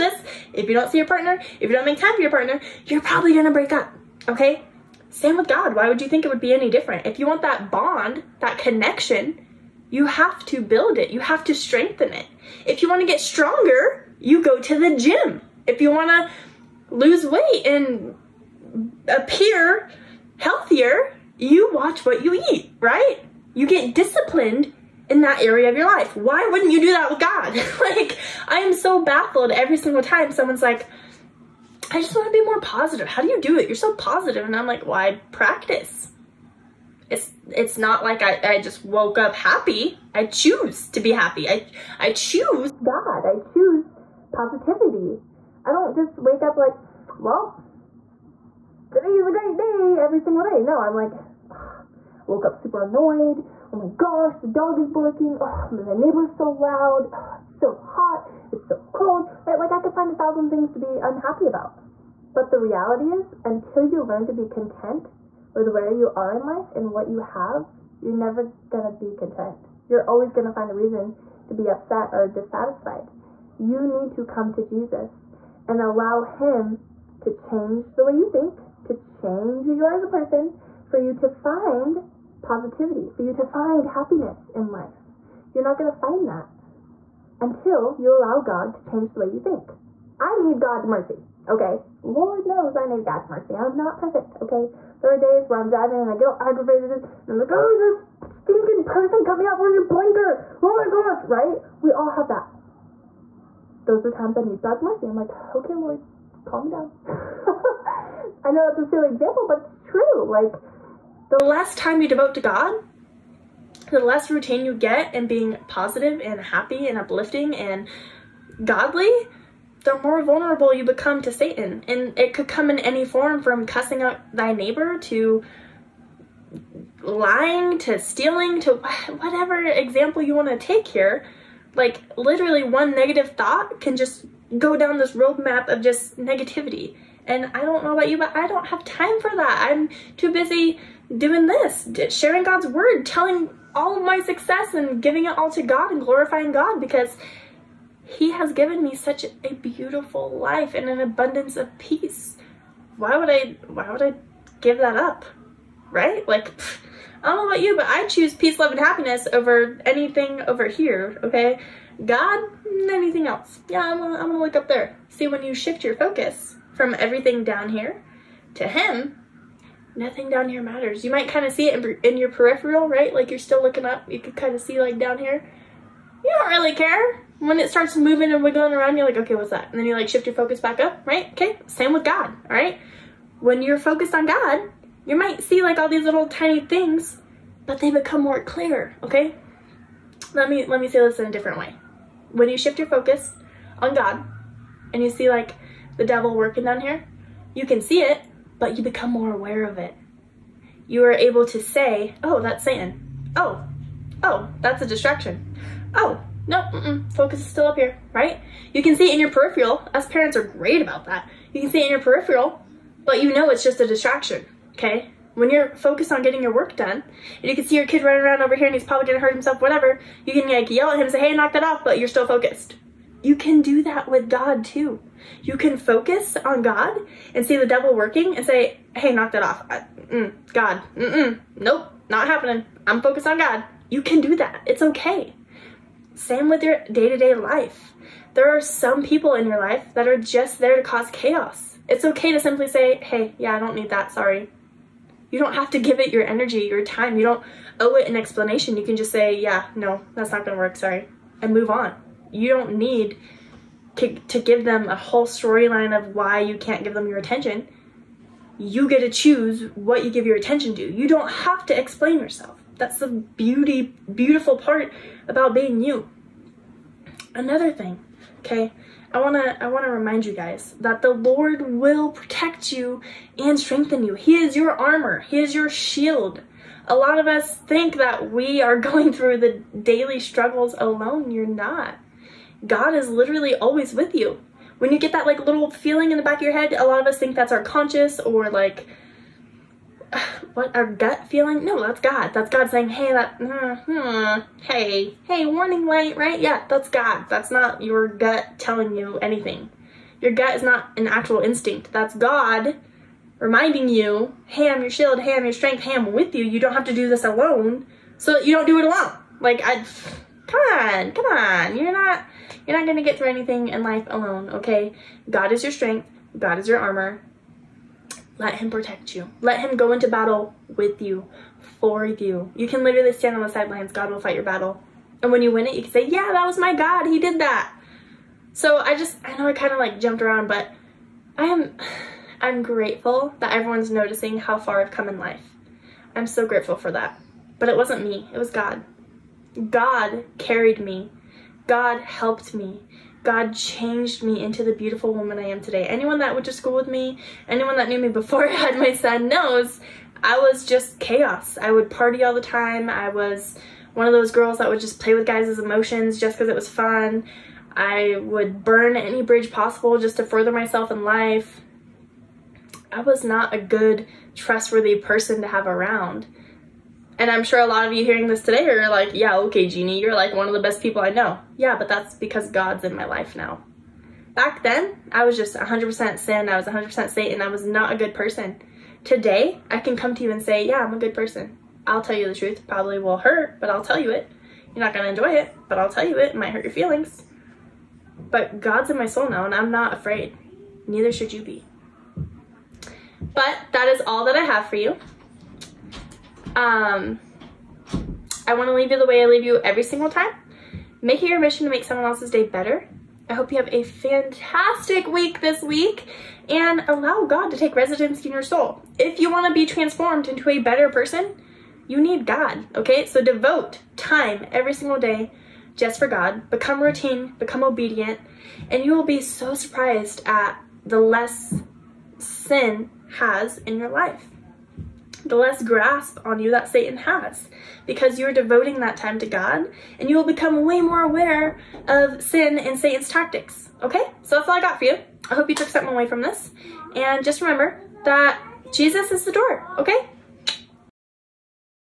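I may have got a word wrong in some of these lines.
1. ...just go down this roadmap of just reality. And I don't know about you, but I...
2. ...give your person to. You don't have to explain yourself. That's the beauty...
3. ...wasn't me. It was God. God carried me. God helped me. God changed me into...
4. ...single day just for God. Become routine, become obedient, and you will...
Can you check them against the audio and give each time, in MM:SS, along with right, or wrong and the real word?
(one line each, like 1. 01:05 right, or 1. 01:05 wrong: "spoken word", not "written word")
1. 02:13 wrong: "negativity", not "reality"
2. 04:20 wrong: "attention", not "person"
3. 05:37 right
4. 06:54 right.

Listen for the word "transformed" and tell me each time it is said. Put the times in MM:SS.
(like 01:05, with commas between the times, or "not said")
06:49.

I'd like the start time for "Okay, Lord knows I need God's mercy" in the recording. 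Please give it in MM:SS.
01:31.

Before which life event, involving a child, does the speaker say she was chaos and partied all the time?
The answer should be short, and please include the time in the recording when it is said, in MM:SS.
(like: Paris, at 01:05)
had my son, at 05:48.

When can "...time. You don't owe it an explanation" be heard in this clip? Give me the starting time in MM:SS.
04:06.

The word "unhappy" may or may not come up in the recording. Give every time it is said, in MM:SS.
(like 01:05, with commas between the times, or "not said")
01:01.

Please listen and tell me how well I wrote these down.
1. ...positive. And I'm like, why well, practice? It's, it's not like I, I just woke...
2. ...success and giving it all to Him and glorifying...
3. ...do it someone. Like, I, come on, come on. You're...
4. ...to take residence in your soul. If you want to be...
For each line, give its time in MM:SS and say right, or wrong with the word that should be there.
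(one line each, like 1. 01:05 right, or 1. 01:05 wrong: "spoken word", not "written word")
1. 00:33 right
2. 02:24 wrong: "God", not "Him"
3. 05:08 wrong: "alone", not "someone"
4. 06:47 right.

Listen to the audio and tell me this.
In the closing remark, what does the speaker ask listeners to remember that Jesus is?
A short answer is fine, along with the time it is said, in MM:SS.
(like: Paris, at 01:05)
the door, at 07:19.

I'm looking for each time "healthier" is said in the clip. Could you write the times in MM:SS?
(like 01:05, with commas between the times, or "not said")
00:20.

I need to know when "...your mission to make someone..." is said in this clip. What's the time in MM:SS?
06:41.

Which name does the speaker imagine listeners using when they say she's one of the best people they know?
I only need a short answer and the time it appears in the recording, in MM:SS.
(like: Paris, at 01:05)
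Jeannie, at 06:09.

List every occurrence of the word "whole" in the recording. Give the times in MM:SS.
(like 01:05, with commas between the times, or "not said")
04:14.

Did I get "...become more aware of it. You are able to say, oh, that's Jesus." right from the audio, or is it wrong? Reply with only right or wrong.
wrong.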